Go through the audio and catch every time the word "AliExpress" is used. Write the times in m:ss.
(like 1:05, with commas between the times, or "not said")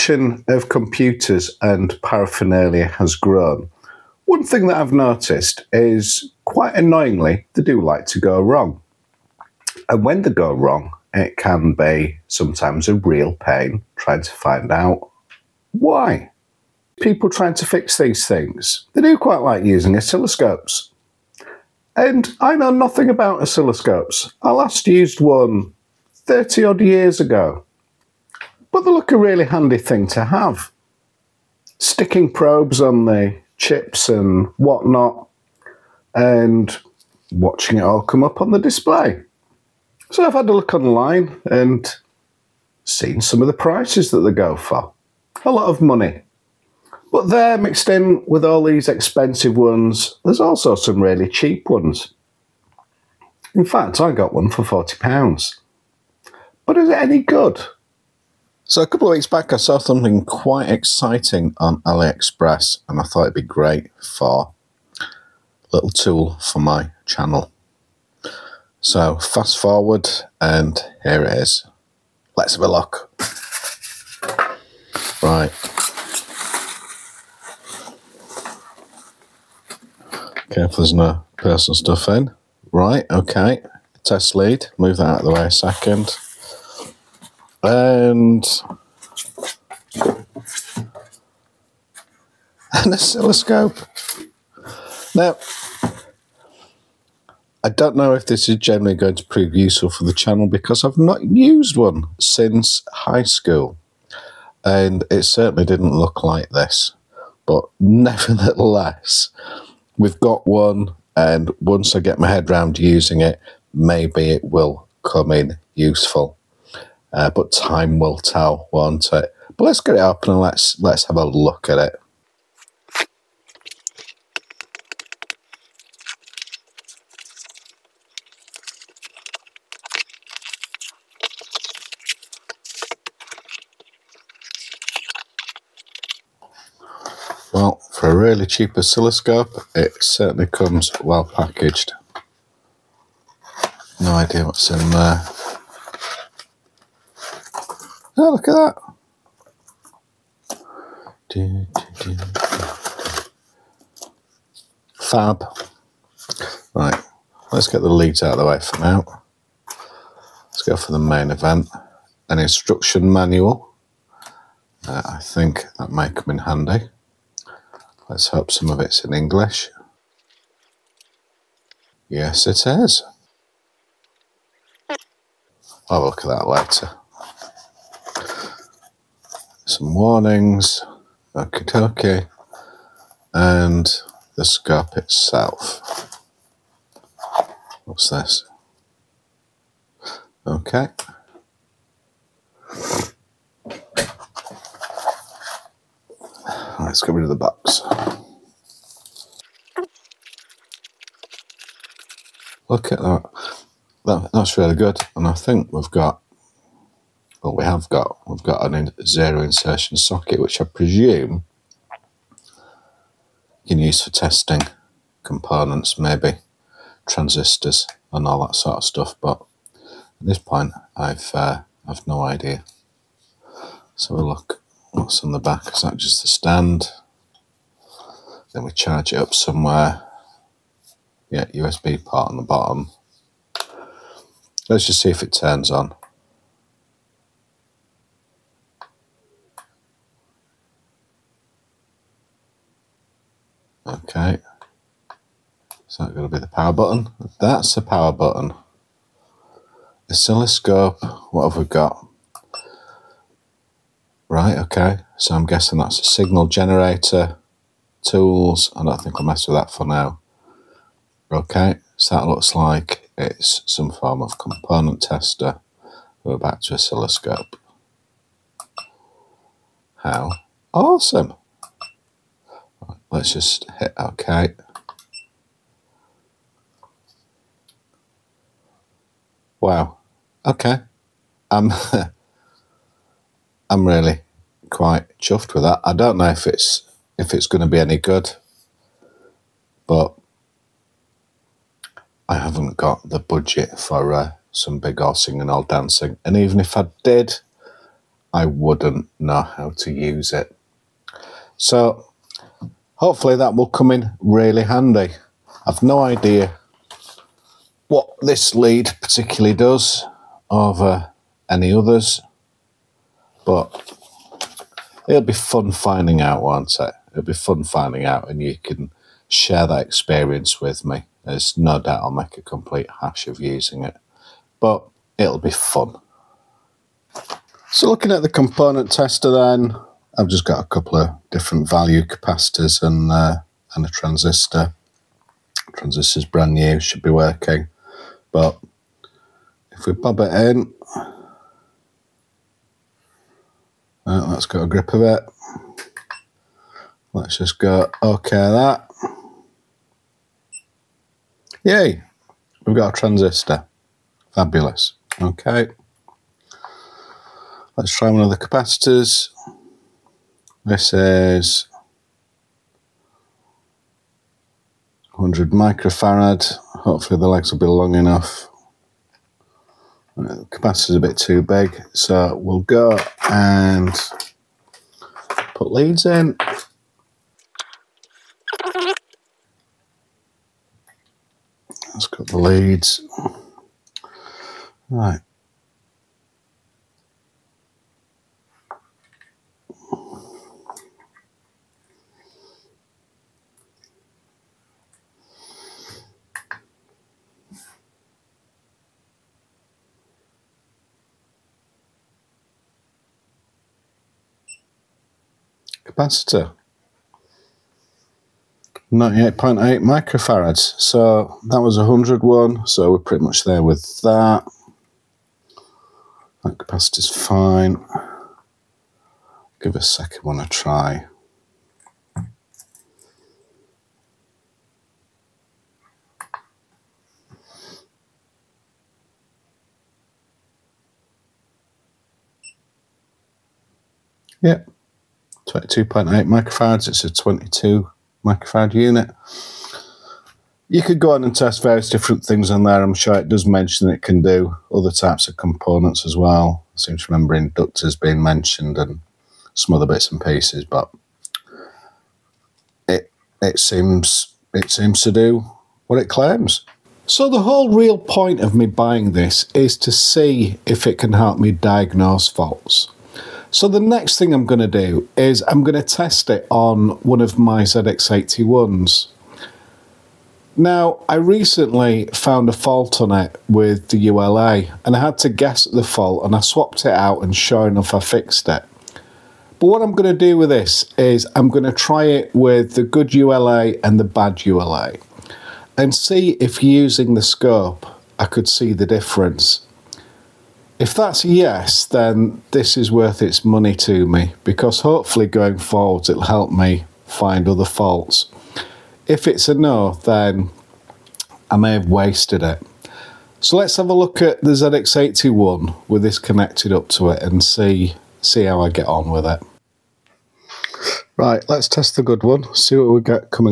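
1:01.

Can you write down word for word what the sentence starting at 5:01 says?
So Hopefully that will come in really handy.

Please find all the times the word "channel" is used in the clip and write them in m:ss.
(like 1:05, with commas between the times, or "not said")
1:07, 1:40.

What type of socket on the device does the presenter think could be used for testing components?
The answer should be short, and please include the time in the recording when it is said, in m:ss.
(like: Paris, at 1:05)
zero insertion socket, at 3:29.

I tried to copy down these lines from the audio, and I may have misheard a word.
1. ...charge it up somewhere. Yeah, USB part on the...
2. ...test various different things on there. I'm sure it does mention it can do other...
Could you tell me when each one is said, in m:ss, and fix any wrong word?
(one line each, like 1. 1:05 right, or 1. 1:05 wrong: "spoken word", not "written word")
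1. 3:48 right
2. 7:21 right.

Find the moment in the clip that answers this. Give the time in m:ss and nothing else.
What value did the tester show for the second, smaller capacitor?
7:15.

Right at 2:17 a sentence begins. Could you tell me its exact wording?
Well, for a really cheap oscilloscope, it certainly comes well packaged.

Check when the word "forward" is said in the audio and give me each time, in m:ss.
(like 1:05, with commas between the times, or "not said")
1:09, 8:15.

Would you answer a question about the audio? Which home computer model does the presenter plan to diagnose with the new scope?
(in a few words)
ZX81.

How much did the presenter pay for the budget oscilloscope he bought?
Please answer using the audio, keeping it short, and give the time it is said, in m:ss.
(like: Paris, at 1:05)
£40, at 0:54.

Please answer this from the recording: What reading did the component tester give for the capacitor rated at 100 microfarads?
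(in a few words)
98.8 microfarads.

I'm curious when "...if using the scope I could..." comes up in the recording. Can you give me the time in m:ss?
8:06.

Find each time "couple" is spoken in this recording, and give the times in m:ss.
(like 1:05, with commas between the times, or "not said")
0:58, 5:30.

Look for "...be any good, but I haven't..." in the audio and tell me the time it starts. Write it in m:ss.
4:47.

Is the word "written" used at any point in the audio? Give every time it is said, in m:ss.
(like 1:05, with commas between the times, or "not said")
not said.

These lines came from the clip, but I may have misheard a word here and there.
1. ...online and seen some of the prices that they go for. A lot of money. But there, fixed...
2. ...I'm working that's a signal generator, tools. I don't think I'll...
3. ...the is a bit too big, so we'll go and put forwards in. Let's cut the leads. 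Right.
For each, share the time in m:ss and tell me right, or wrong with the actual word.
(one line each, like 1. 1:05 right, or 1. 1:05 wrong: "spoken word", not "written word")
1. 0:40 wrong: "mixed", not "fixed"
2. 4:15 wrong: "guessing", not "working"
3. 6:10 wrong: "leads", not "forwards".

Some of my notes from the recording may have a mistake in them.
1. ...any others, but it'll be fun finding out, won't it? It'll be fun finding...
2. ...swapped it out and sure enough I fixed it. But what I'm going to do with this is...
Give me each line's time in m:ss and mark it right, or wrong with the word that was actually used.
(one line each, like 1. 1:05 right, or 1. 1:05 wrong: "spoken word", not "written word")
1. 5:11 right
2. 7:56 right.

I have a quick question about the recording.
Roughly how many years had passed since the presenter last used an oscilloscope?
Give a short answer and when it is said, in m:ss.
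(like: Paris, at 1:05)
30, at 0:26.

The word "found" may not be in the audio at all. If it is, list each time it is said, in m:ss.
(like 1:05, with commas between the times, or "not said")
7:52.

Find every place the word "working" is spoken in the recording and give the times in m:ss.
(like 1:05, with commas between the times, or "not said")
5:37.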